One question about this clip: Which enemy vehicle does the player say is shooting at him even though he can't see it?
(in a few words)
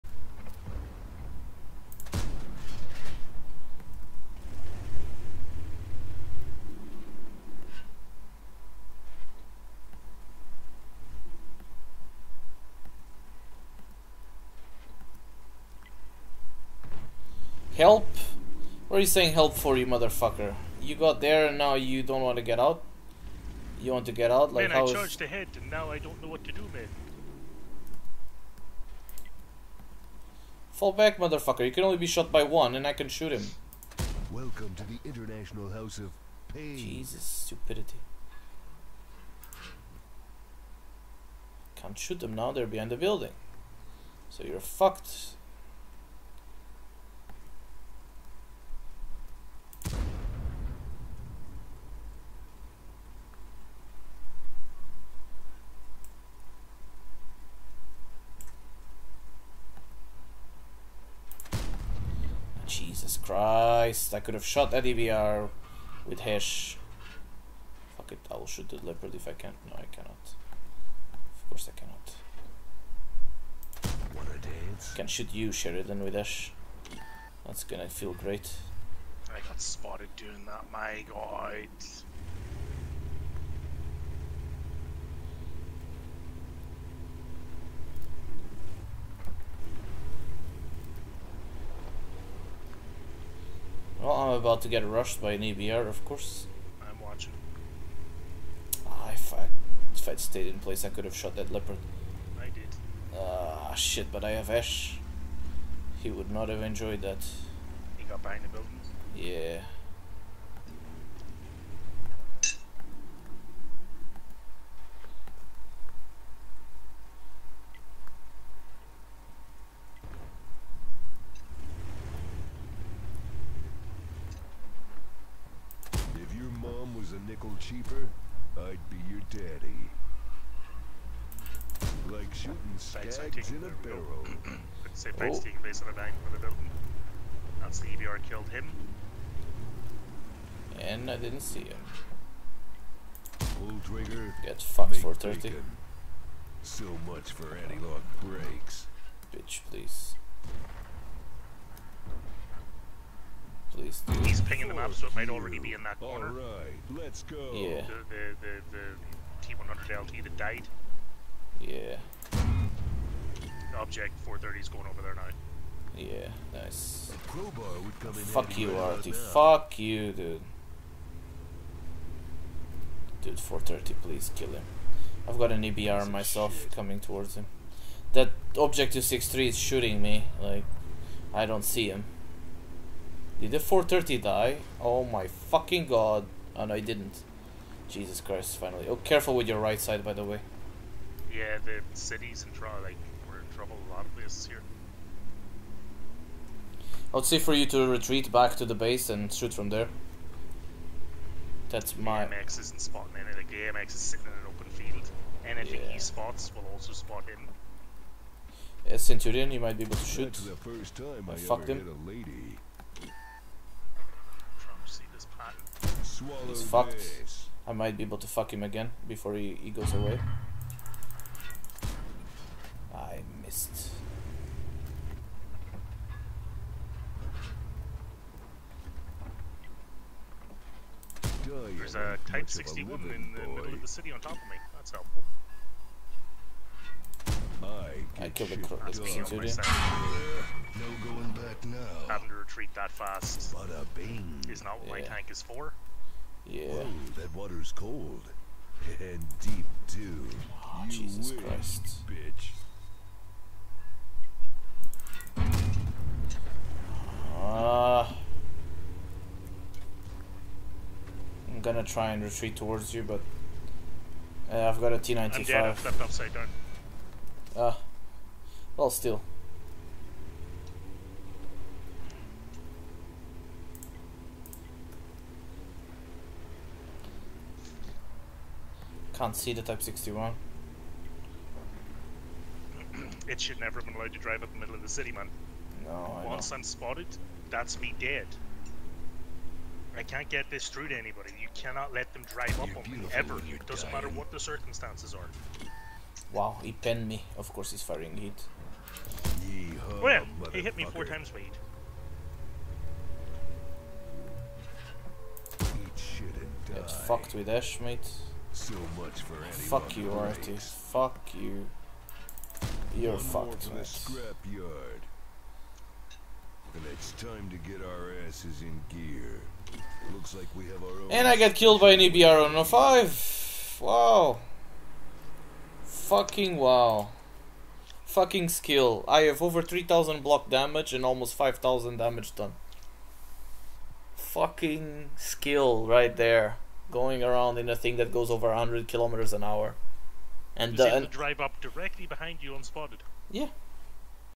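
Object 263.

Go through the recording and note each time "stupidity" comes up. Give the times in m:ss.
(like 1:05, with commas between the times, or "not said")
0:37.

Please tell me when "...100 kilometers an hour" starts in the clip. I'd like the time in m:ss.
5:38.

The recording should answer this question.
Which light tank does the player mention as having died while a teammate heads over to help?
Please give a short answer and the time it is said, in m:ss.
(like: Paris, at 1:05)
T100 LT, at 2:39.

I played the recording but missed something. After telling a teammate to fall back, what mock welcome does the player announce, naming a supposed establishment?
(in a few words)
International House of Pain.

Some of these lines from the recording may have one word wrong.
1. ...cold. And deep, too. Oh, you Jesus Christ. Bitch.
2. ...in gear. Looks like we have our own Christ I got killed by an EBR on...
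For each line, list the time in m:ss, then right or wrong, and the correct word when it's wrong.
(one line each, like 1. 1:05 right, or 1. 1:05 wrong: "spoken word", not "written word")
1. 4:07 right
2. 5:18 wrong: "And", not "Christ".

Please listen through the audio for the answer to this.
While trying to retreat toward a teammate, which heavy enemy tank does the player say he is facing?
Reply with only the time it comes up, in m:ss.
4:24.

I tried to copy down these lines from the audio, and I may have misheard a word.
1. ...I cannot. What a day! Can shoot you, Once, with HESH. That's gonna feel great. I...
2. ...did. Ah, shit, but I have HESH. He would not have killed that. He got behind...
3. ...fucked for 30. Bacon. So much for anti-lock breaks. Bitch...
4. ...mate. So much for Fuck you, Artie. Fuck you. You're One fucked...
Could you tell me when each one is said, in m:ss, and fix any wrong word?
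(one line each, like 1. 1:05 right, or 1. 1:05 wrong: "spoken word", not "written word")
1. 1:11 wrong: "Sheridan", not "Once"
2. 1:42 wrong: "enjoyed", not "killed"
3. 2:24 right
4. 5:07 right.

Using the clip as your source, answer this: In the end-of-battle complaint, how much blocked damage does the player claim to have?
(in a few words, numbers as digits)
over 3000.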